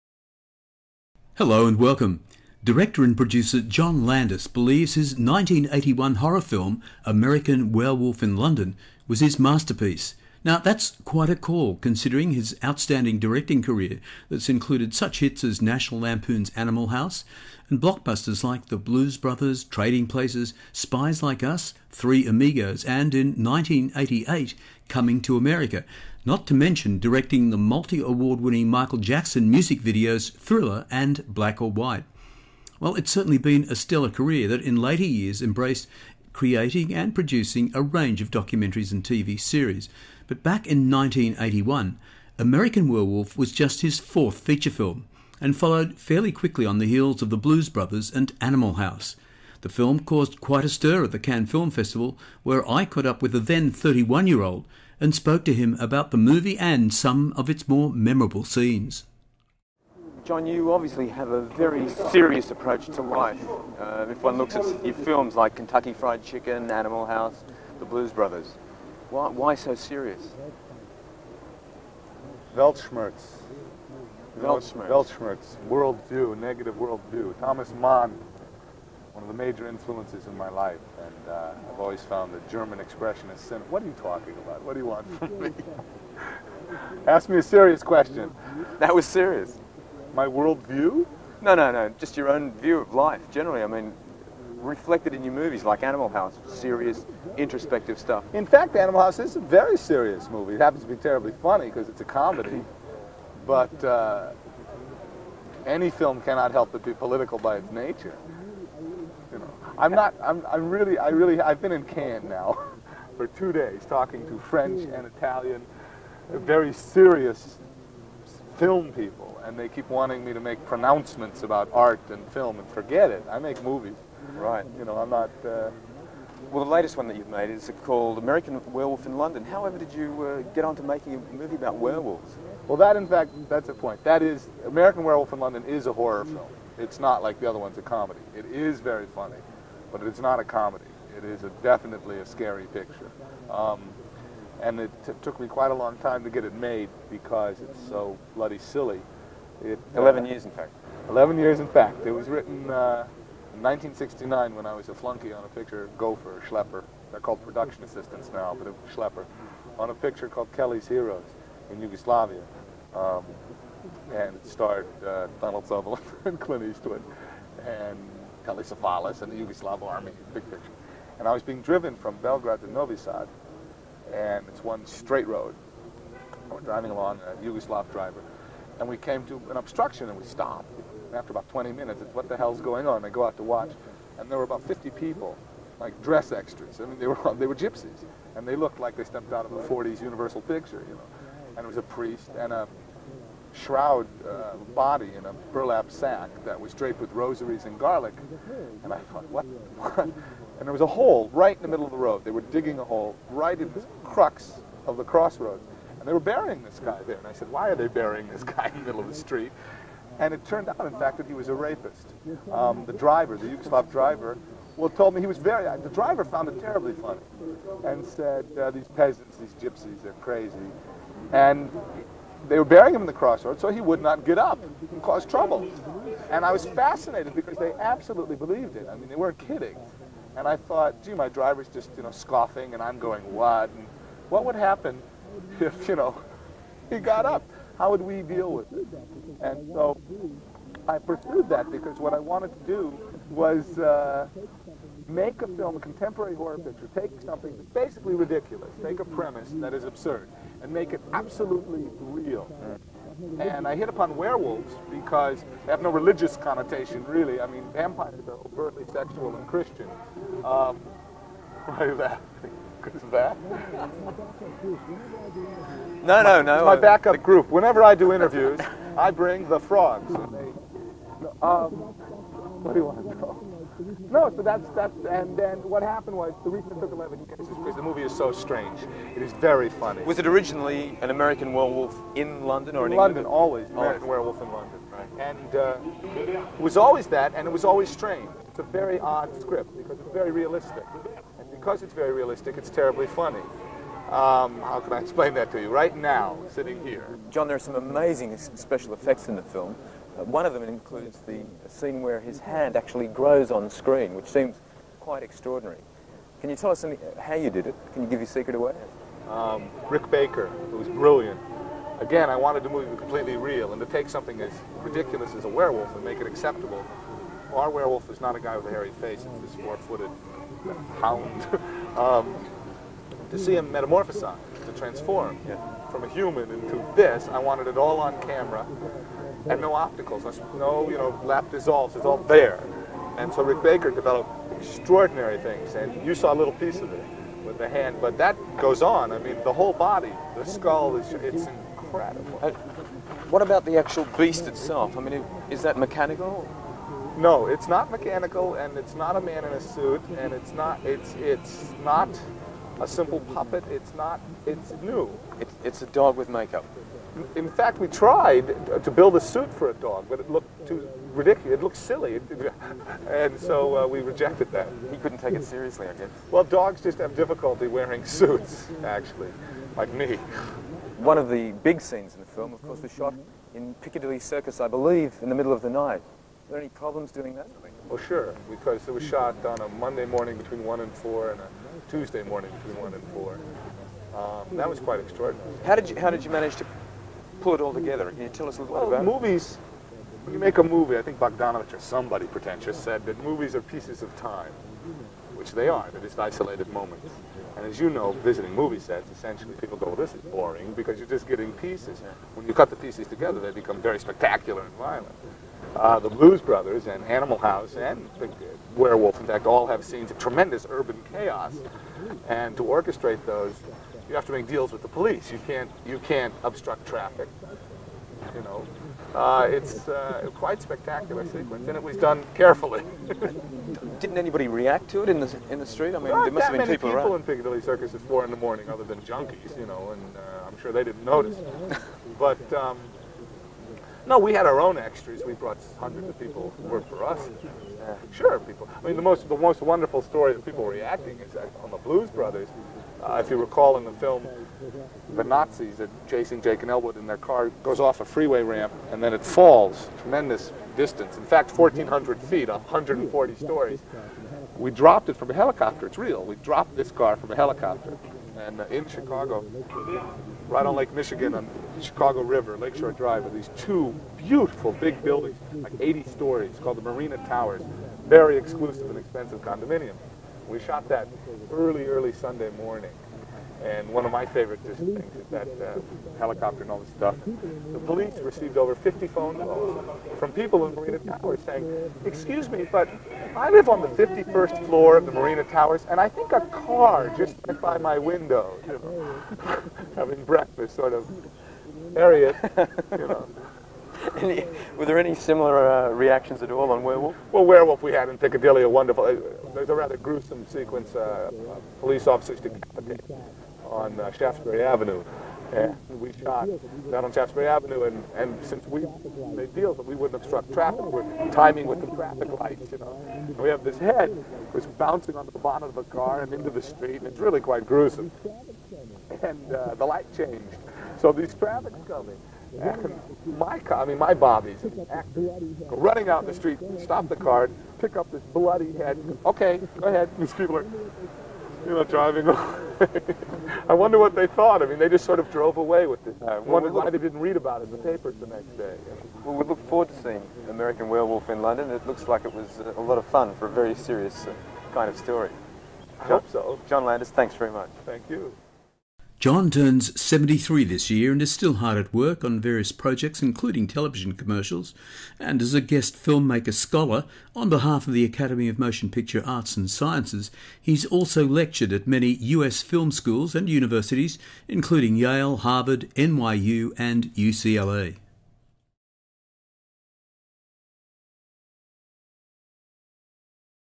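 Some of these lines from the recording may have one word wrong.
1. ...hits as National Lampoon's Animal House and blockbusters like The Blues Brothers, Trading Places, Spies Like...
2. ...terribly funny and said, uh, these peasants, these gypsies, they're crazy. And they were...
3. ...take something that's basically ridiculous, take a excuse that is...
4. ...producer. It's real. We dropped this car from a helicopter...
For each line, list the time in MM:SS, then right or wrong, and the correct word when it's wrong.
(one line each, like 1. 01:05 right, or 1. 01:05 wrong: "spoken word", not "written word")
1. 00:15 right
2. 03:36 right
3. 04:06 wrong: "premise", not "excuse"
4. 07:35 wrong: "helicopter", not "producer".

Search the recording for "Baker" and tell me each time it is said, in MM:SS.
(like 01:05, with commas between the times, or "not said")
05:10, 05:33.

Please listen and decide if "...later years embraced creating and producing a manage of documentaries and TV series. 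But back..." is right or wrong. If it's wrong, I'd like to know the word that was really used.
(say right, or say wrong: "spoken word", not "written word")
wrong: "range", not "manage".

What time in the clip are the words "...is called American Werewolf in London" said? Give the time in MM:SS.
02:07.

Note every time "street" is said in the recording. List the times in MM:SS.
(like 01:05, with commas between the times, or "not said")
03:29, 07:05, 08:36, 08:46.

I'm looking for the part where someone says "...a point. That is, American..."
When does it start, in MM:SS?
02:13.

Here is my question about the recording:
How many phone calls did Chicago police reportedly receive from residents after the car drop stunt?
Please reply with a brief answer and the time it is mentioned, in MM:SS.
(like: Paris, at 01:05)
50, at 07:58.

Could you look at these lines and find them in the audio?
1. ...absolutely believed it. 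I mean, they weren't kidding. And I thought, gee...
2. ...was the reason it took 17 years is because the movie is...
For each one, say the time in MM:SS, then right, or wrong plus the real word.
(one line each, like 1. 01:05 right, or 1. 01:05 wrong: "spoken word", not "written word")
1. 03:47 right
2. 04:36 wrong: "11", not "17".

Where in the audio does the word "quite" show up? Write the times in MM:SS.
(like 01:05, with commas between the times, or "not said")
00:11, 00:50, 02:25, 05:04, 06:24, 07:00, 08:37.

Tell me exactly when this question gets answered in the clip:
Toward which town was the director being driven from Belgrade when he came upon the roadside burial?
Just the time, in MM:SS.
02:52.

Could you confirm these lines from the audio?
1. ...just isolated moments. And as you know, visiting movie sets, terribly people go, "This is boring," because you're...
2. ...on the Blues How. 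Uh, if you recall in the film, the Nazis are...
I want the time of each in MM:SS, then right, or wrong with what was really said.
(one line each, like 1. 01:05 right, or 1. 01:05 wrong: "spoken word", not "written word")
1. 06:36 wrong: "essentially", not "terribly"
2. 07:21 wrong: "Brothers", not "How".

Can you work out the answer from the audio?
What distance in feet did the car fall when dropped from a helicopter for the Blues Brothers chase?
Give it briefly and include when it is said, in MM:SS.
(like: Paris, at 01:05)
1,400 feet, at 07:31.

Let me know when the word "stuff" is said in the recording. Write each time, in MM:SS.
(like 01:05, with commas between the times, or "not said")
01:37, 07:56.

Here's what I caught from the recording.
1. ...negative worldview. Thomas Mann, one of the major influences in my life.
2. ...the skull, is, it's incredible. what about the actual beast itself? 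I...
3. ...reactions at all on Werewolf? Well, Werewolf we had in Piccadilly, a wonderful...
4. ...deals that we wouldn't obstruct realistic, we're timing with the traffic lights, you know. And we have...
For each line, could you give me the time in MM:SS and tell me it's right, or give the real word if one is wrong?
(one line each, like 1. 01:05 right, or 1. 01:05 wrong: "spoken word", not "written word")
1. 01:16 right
2. 05:40 right
3. 08:15 right
4. 08:29 wrong: "traffic", not "realistic".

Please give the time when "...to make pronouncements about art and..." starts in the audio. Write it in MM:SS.
02:00.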